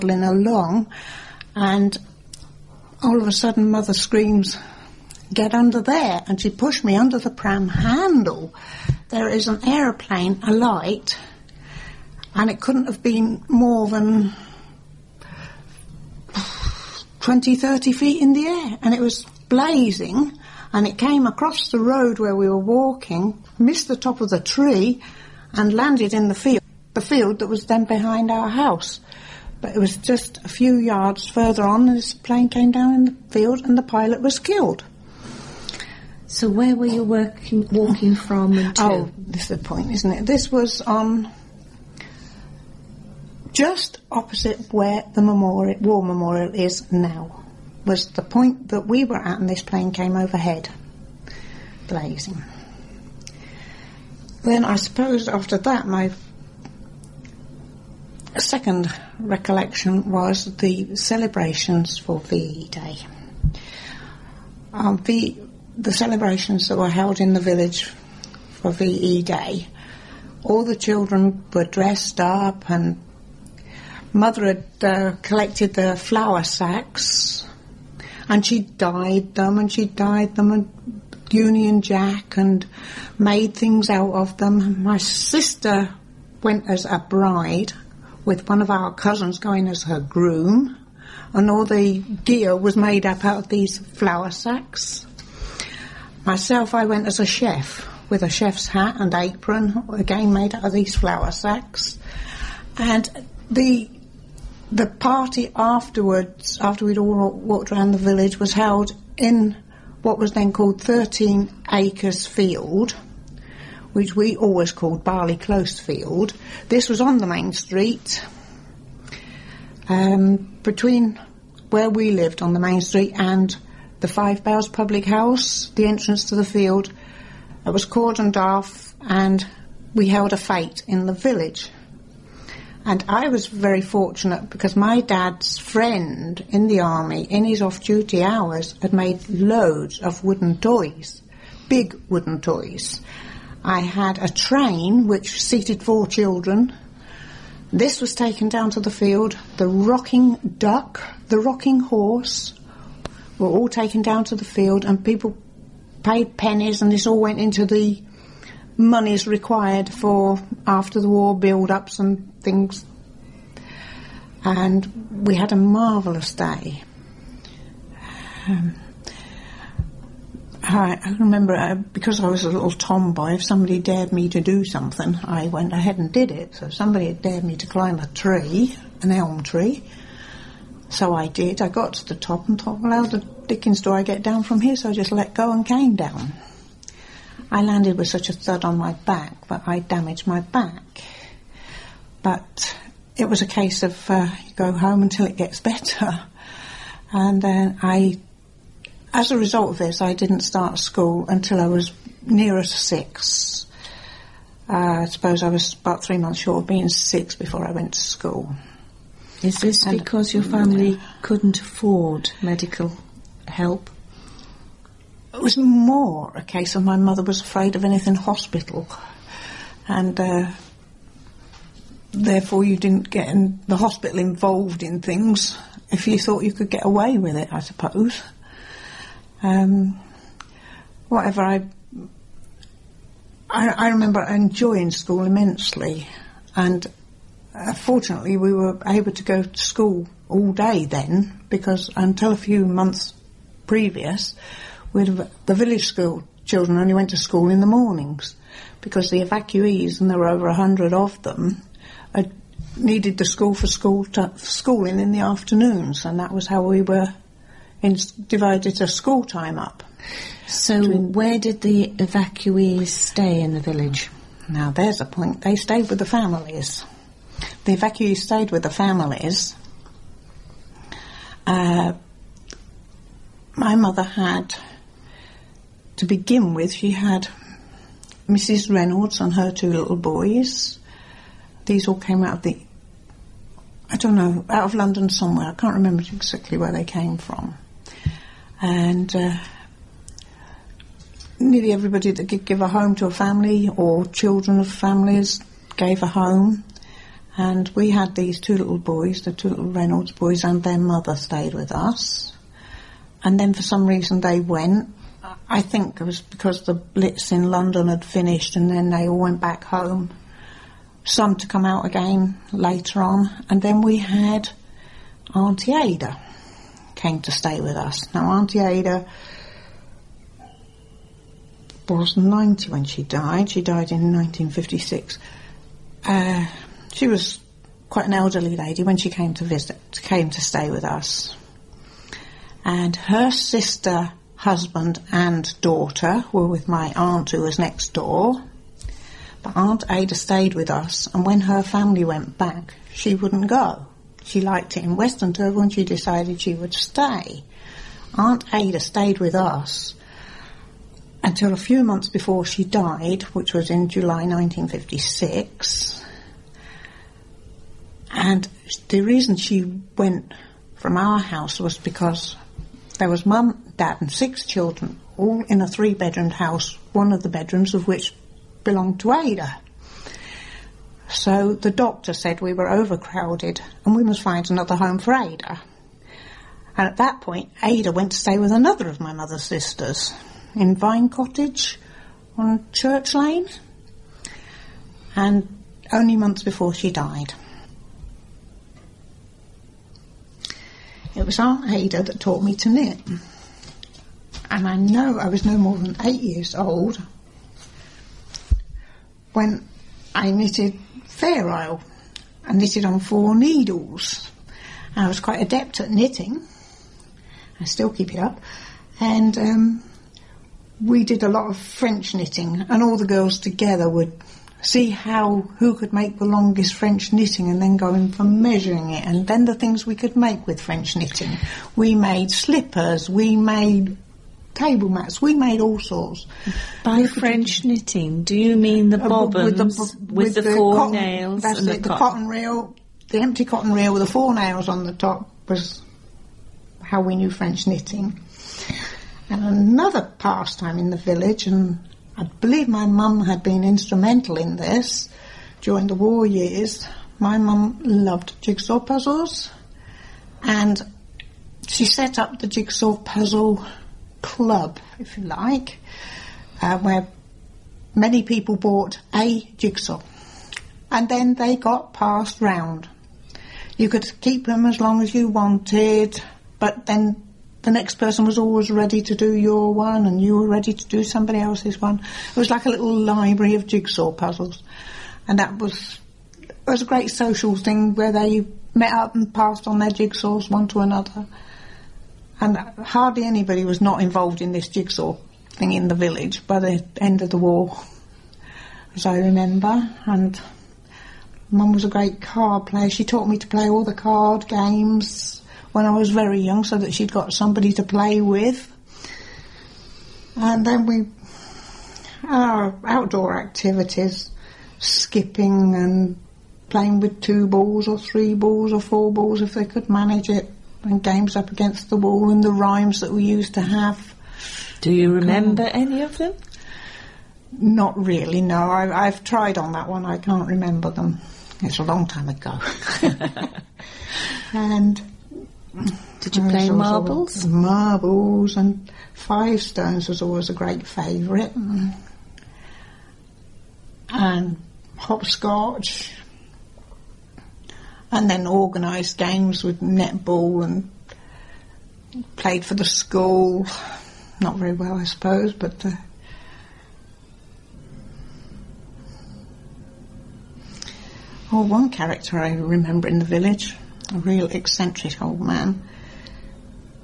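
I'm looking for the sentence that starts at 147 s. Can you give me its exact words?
This was taken down to the field.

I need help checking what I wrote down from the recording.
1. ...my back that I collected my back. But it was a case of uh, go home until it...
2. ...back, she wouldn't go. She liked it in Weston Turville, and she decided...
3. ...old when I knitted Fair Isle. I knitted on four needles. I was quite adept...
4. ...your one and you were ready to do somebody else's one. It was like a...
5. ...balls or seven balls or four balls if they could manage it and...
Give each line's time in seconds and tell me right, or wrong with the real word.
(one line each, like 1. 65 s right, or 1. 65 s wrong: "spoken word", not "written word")
1. 188 s wrong: "damaged", not "collected"
2. 342 s right
3. 396 s right
4. 469 s right
5. 507 s wrong: "three", not "seven".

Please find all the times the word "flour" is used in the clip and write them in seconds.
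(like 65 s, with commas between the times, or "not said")
75 s, 93 s, 100 s.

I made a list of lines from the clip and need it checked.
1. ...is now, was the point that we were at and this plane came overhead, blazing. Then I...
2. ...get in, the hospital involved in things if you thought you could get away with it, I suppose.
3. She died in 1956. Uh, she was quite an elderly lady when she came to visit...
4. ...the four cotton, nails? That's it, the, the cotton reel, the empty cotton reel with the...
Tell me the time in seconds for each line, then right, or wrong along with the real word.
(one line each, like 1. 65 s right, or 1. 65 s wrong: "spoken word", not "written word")
1. 46 s right
2. 223 s right
3. 323 s right
4. 430 s right.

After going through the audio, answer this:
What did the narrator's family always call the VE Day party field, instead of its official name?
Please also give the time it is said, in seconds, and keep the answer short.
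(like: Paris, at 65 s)
Barley Close Field, at 115 s.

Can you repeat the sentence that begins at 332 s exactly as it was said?
And her sister, husband, and daughter were with my aunt who was next door.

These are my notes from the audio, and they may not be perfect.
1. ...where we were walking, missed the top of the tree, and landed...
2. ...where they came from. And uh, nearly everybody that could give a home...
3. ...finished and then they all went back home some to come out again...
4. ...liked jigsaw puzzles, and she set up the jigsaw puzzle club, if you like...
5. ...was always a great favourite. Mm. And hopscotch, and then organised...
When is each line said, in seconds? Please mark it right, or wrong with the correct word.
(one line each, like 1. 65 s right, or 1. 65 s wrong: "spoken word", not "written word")
1. 22 s right
2. 286 s right
3. 308 s right
4. 447 s wrong: "loved", not "liked"
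5. 530 s right.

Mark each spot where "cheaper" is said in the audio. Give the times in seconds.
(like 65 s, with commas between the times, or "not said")
not said.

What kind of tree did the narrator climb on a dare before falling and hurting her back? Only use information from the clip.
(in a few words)
Elm.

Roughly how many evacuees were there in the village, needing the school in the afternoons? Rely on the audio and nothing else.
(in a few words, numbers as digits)
Over 100.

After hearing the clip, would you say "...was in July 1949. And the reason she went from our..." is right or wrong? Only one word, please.
wrong.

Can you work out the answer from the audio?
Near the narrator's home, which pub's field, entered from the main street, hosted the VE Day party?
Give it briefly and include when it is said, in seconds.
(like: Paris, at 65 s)
Five Bells, at 124 s.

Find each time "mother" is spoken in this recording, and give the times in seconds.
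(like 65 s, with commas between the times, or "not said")
3 s, 74 s, 216 s, 273 s, 300 s, 379 s.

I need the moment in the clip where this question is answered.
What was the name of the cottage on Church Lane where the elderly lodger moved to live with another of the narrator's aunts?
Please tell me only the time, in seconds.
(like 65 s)
380 s.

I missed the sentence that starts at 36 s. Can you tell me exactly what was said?
So where were you working, walking from?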